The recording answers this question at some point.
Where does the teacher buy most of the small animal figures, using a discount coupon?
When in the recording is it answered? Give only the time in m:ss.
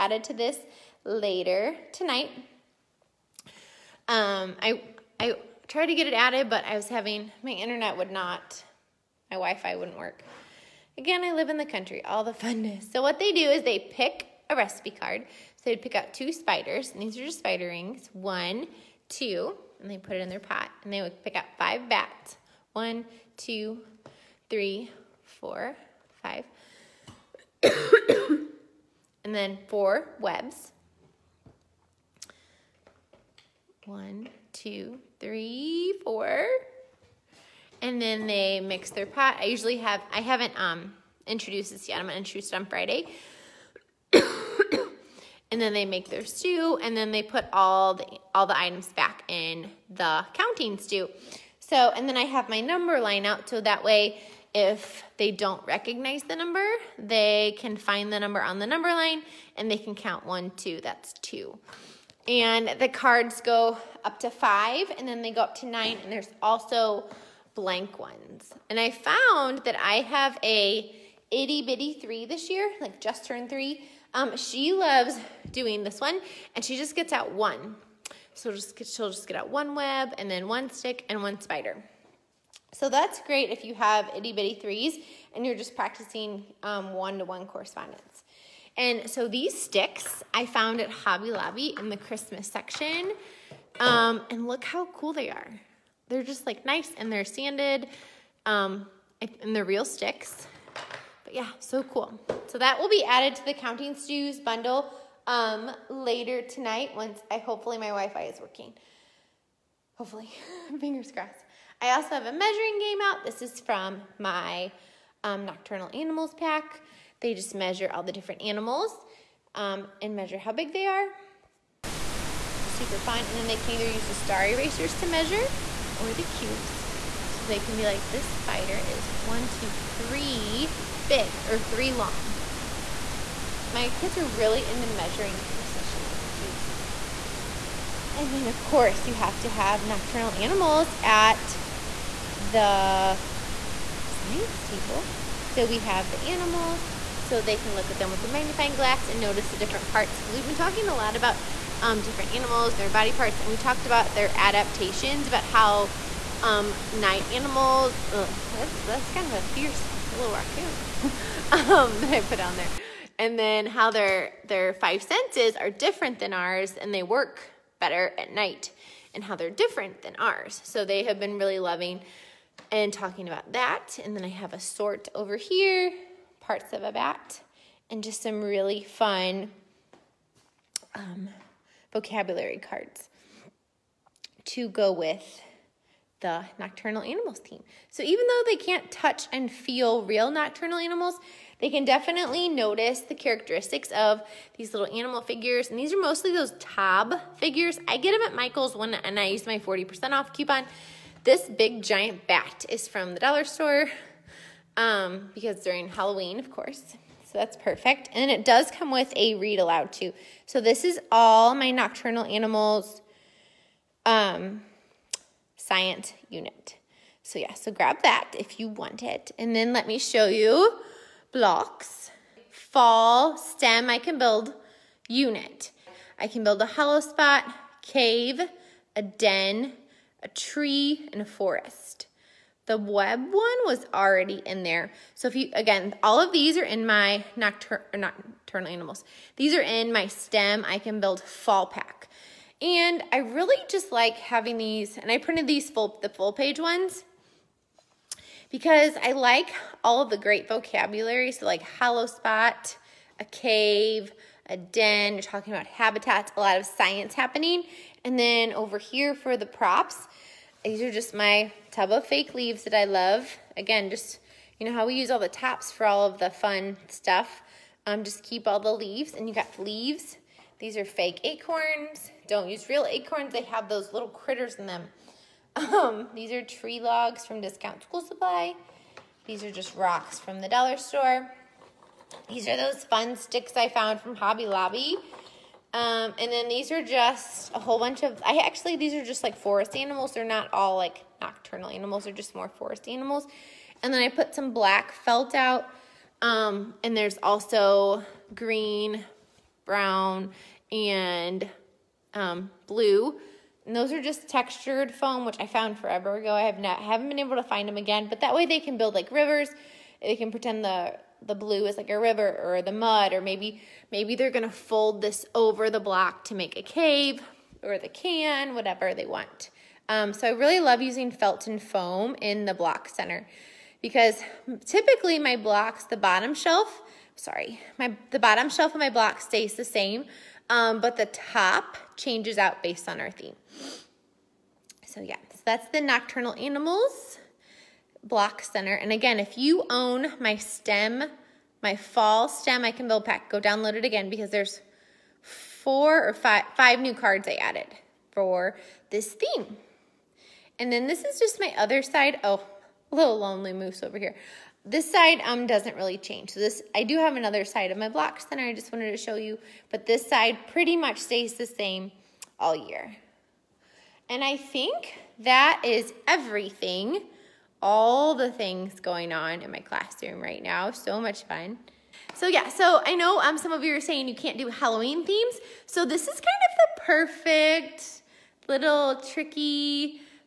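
3:18.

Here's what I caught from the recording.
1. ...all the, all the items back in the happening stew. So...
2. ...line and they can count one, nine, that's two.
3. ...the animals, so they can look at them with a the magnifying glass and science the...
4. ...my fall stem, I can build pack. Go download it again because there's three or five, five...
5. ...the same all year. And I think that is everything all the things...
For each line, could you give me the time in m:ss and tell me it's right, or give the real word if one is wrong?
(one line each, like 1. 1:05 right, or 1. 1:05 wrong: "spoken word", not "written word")
1. 0:47 wrong: "counting", not "happening"
2. 0:58 wrong: "two", not "nine"
3. 2:26 wrong: "notice", not "science"
4. 5:41 wrong: "four", not "three"
5. 6:01 right.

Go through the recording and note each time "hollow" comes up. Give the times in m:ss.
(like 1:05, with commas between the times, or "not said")
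3:46, 4:11.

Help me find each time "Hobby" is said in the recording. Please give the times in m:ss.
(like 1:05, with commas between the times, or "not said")
1:30, 4:44.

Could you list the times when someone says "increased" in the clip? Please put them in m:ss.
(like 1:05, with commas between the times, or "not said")
not said.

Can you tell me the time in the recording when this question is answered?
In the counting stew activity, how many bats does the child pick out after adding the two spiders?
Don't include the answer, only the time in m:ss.
0:21.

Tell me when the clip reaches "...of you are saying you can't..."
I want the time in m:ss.
6:13.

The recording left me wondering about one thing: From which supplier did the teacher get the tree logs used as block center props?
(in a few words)
Discount School Supply.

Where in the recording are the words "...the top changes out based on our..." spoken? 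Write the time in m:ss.
5:30.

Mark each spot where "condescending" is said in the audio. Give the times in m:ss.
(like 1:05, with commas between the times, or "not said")
not said.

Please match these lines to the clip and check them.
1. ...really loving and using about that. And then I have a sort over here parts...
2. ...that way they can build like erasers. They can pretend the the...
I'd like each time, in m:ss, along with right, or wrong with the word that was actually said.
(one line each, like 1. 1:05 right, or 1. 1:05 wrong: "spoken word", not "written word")
1. 2:51 wrong: "talking", not "using"
2. 5:08 wrong: "rivers", not "erasers".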